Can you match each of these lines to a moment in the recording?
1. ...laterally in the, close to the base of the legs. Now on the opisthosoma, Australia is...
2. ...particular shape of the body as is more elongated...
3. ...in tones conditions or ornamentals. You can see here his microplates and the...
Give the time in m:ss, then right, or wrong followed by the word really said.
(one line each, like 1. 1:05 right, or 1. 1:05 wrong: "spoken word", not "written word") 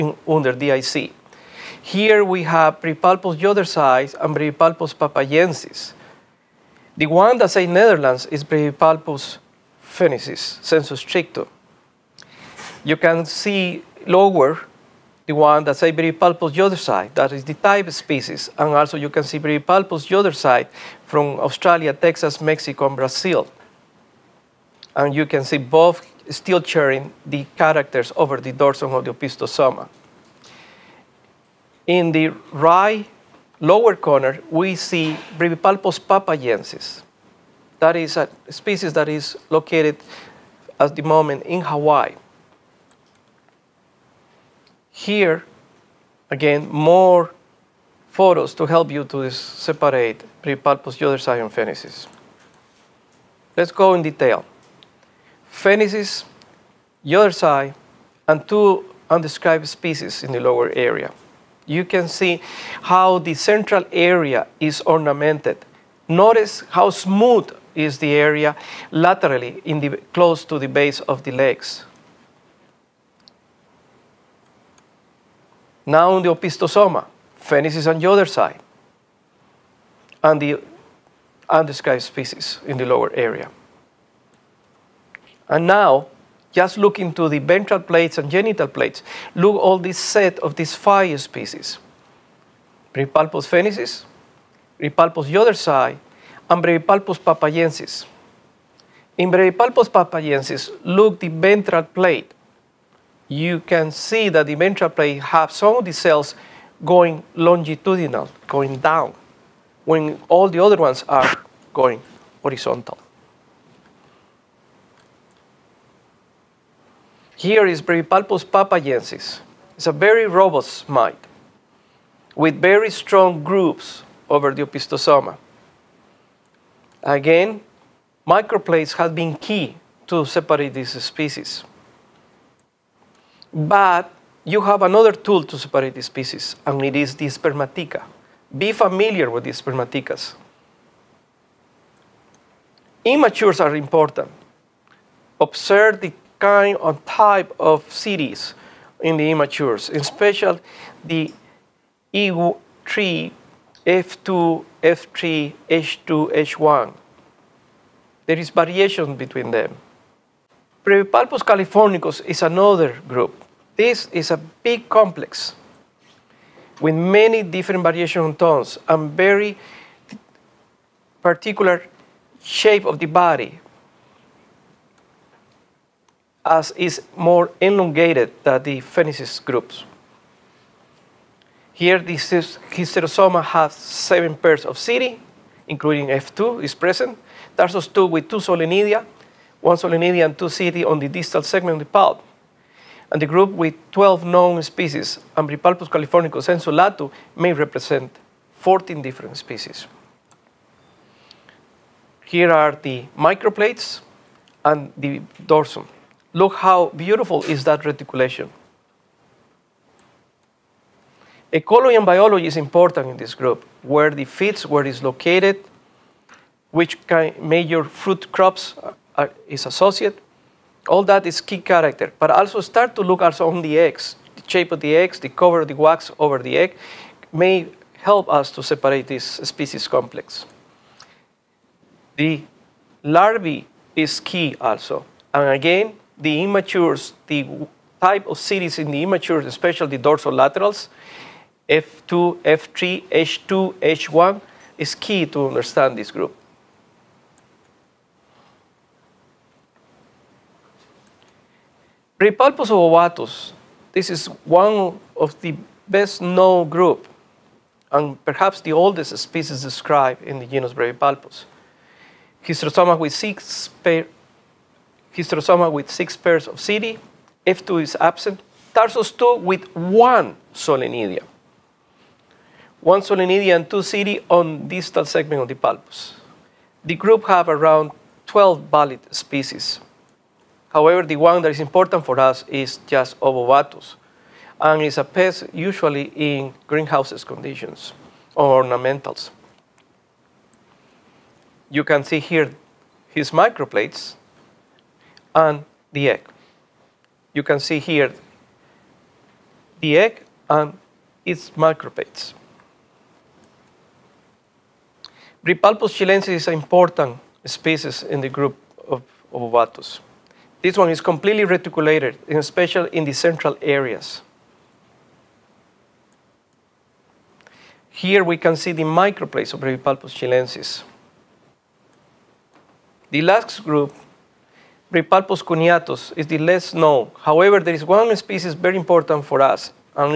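1. 1:08 wrong: "Phoenix", not "Australia"
2. 2:51 right
3. 4:46 wrong: "greenhouses", not "tones".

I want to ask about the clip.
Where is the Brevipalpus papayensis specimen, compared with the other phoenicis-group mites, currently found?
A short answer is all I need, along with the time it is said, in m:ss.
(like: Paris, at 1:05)
Hawaii, at 0:41.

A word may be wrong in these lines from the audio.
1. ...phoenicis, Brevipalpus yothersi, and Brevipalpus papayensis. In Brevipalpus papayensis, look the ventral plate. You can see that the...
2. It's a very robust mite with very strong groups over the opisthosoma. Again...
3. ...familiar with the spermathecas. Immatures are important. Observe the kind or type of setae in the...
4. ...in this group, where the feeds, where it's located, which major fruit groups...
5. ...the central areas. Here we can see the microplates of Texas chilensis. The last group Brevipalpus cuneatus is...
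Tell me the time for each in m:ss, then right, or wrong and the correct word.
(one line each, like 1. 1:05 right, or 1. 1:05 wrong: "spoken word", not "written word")
1. 1:33 right
2. 1:59 right
3. 2:18 right
4. 3:33 wrong: "crops", not "groups"
5. 5:13 wrong: "Brevipalpus", not "Texas".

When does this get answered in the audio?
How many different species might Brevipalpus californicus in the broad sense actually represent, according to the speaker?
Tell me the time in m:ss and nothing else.
3:18.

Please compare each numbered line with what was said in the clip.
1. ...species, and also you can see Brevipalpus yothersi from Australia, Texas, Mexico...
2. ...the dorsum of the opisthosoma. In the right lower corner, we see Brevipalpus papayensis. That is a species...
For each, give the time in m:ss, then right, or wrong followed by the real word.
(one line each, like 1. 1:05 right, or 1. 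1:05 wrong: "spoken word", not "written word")
1. 0:17 right
2. 0:28 right.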